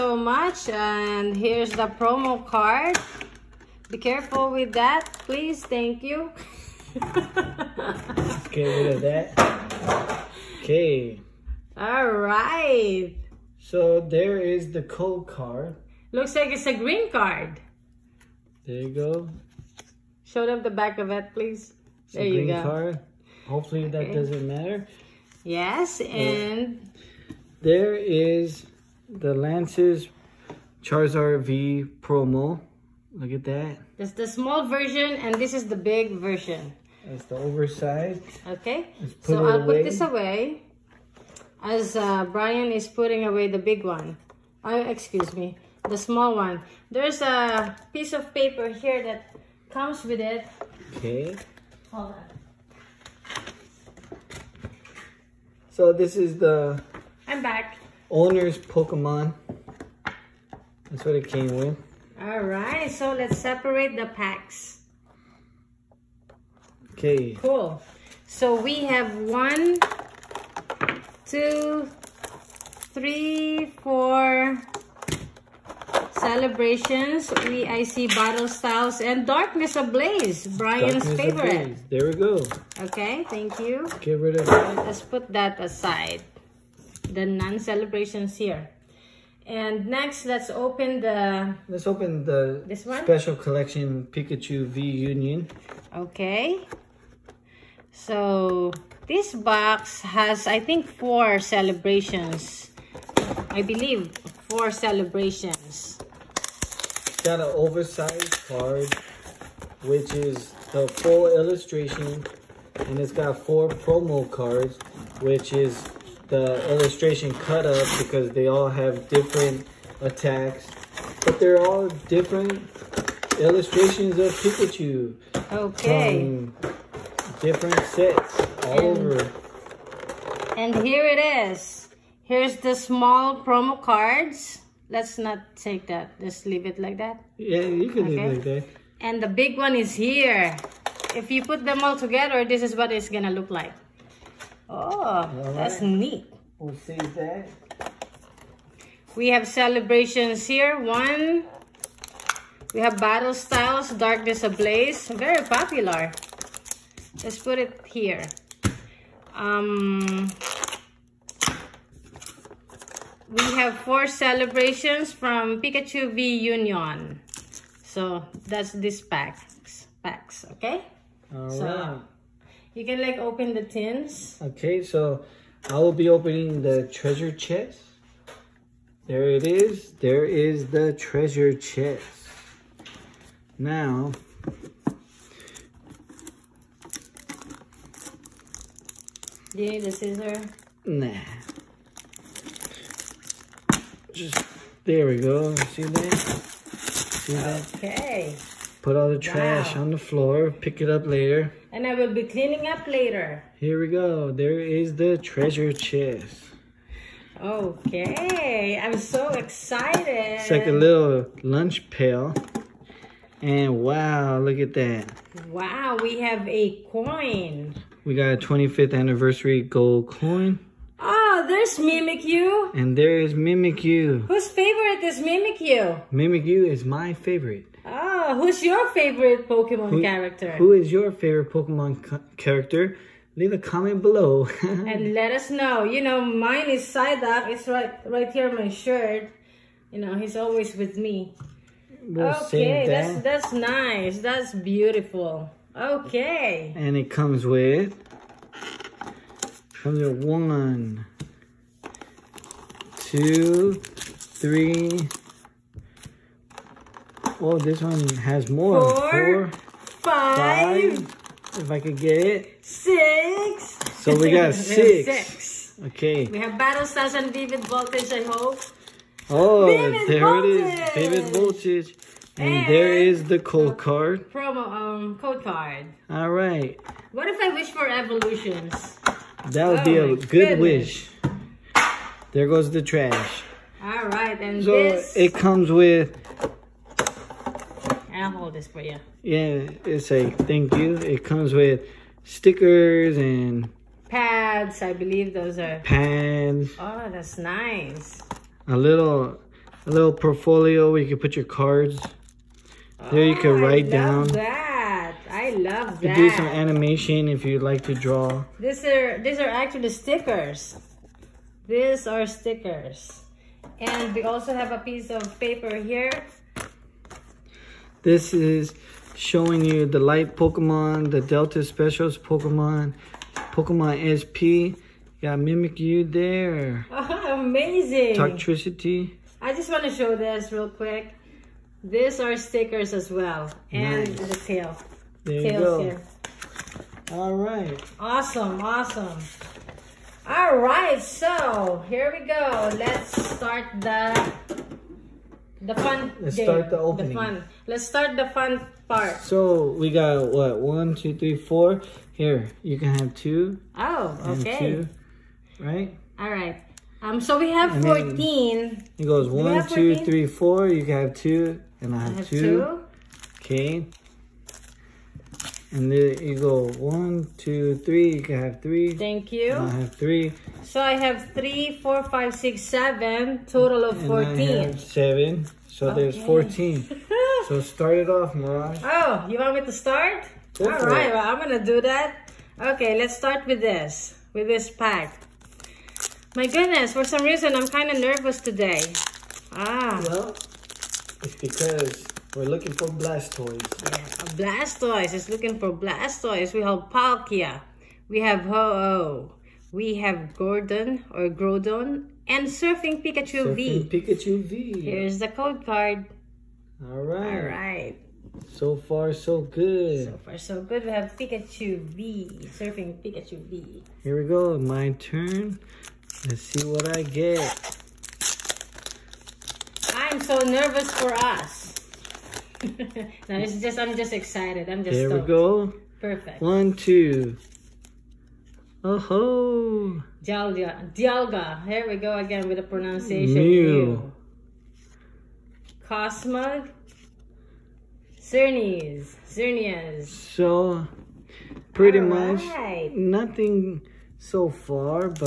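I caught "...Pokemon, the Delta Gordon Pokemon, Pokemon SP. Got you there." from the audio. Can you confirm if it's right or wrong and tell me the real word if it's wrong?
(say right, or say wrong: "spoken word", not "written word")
wrong: "Specials", not "Gordon".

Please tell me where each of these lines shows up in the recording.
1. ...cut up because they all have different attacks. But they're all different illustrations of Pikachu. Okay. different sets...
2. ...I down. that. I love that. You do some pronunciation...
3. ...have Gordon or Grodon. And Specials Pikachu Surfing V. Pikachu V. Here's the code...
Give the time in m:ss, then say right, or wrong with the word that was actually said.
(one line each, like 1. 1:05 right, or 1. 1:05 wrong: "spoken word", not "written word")
1. 1:57 right
2. 5:03 wrong: "animation", not "pronunciation"
3. 6:39 wrong: "Surfing", not "Specials".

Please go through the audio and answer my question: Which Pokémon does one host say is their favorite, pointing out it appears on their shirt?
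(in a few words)
Psyduck.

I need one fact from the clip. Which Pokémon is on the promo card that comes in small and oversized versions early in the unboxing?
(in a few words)
Lance's Charizard V.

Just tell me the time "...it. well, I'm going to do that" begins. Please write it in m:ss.
6:21.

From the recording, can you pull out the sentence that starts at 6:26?
My goodness, for some reason, I'm kind of nervous today.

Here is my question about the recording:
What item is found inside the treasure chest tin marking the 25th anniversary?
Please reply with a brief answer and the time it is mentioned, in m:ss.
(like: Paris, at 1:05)
Gold coin, at 3:39.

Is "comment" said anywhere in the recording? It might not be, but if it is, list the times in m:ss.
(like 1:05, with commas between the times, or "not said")
3:53.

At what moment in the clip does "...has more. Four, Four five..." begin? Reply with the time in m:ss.
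4:18.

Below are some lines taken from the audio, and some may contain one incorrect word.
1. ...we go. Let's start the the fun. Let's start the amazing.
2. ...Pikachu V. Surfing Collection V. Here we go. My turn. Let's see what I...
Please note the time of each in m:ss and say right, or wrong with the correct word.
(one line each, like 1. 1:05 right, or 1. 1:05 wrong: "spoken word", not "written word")
1. 5:42 wrong: "opening", not "amazing"
2. 6:51 wrong: "Pikachu", not "Collection".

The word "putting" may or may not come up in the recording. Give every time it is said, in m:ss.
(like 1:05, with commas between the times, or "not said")
0:42.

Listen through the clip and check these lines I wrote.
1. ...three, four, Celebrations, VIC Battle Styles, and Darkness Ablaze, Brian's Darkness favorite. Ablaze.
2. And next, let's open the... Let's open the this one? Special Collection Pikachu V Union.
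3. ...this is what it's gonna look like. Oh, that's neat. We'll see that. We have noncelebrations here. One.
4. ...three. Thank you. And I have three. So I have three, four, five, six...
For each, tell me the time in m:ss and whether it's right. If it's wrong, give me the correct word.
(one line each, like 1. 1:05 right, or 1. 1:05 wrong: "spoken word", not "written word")
1. 1:12 right
2. 1:29 right
3. 2:22 wrong: "celebrations", not "noncelebrations"
4. 6:08 right.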